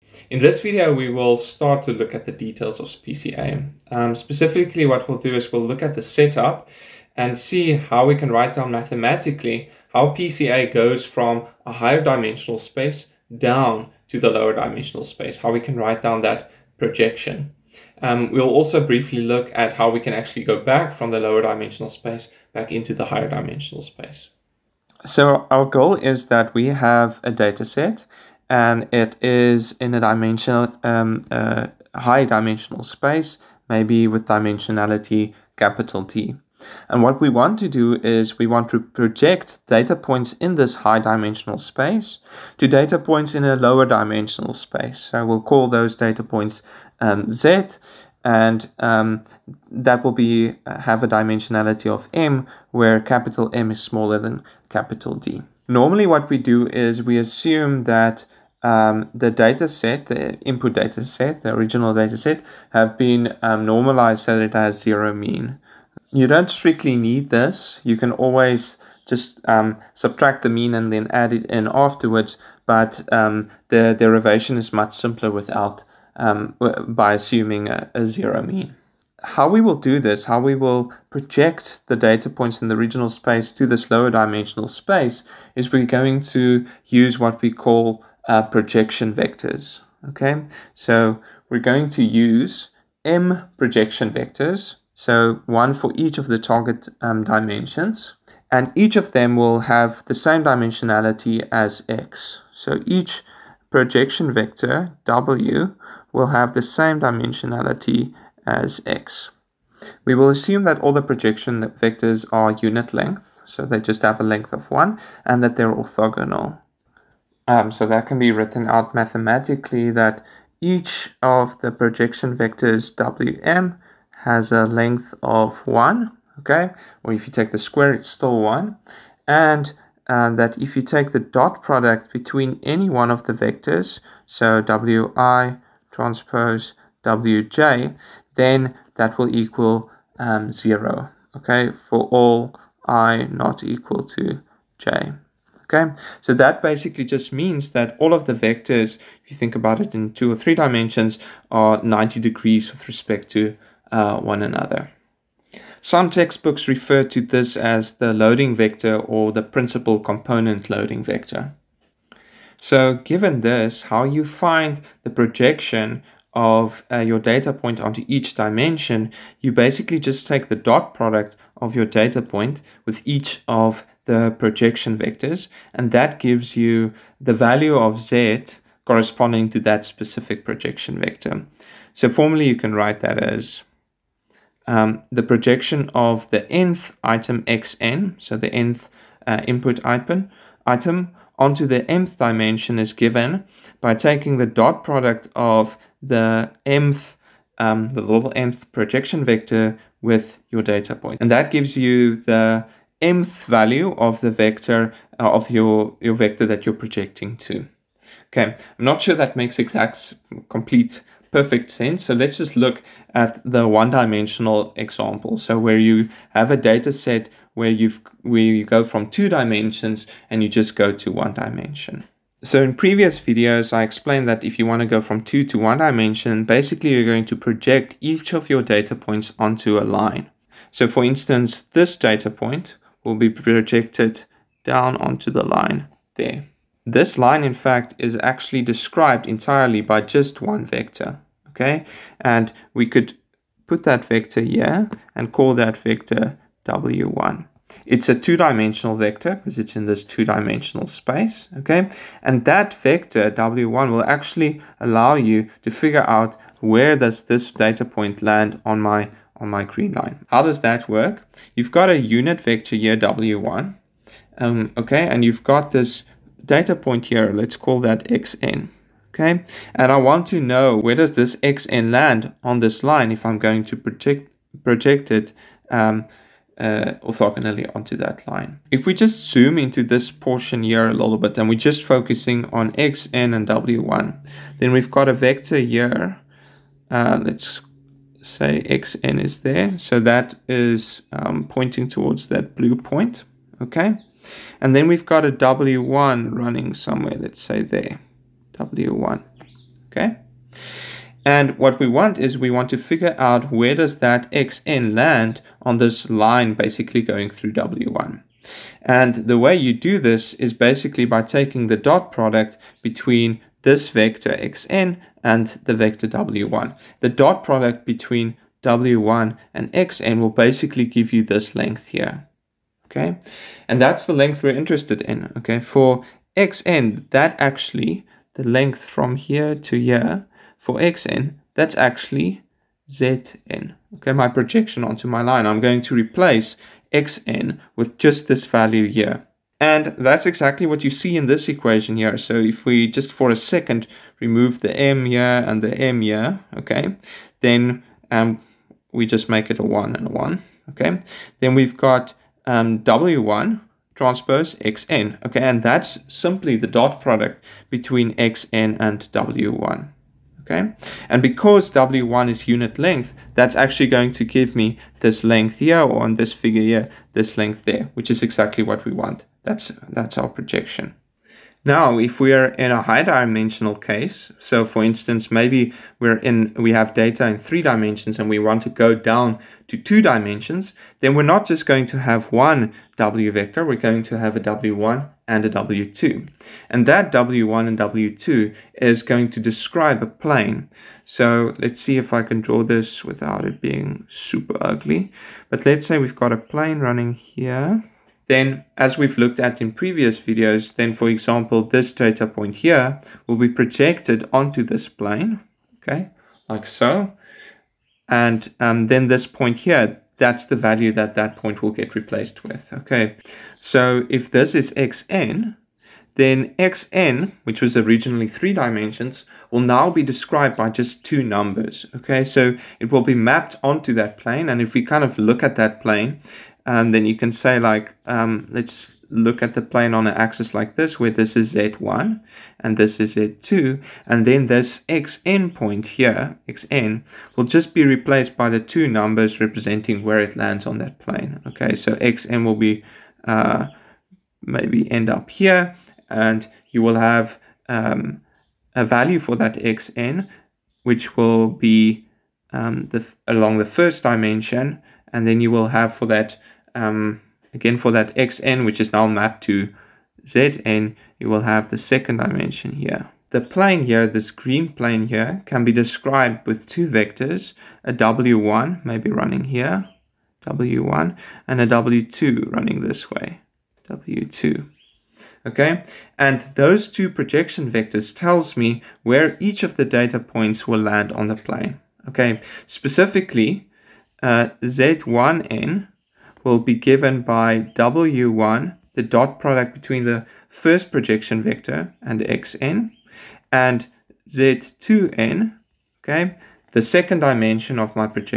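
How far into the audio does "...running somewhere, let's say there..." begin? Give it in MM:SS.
04:56.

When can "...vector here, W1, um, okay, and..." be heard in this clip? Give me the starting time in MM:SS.
04:22.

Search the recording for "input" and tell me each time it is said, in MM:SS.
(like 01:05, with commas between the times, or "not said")
01:00, 03:09.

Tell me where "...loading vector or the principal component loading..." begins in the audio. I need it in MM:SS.
02:38.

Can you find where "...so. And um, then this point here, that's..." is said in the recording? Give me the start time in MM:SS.
06:46.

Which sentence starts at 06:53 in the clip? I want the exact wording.
So if this is xn, then xn, which was originally three dimensions, will now be described by just two numbers, okay?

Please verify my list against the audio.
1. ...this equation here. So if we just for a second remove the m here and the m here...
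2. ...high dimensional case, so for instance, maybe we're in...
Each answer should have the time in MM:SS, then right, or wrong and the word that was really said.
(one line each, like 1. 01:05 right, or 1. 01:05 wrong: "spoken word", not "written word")
1. 05:41 right
2. 06:12 right.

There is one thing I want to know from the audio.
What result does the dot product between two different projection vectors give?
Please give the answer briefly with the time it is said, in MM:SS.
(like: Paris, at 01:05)
0, at 02:20.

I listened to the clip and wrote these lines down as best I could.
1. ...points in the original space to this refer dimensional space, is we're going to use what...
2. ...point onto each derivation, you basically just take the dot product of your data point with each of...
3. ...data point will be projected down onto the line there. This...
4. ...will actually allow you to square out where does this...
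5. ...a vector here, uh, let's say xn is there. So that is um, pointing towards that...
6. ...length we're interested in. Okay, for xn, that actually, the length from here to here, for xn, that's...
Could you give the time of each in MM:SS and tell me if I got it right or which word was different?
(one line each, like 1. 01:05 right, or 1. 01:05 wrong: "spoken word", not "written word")
1. 01:22 wrong: "lower", not "refer"
2. 02:47 wrong: "dimension", not "derivation"
3. 03:51 right
4. 04:13 wrong: "figure", not "square"
5. 04:45 right
6. 05:24 right.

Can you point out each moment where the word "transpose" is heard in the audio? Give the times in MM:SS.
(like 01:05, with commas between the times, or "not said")
02:15, 05:53.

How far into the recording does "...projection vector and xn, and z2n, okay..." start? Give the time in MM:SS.
08:10.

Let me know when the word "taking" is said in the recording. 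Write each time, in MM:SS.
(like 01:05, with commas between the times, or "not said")
03:13, 05:11.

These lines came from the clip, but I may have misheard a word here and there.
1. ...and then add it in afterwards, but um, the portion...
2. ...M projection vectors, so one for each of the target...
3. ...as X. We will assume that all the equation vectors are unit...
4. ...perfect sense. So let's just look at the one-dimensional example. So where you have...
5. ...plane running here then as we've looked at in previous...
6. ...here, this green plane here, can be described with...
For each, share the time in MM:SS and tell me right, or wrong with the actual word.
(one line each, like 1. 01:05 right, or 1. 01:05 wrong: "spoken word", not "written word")
1. 01:10 wrong: "derivation", not "portion"
2. 01:33 right
3. 01:48 wrong: "projection", not "equation"
4. 03:31 right
5. 06:36 right
6. 07:43 right.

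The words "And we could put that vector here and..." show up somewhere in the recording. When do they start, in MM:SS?
04:02.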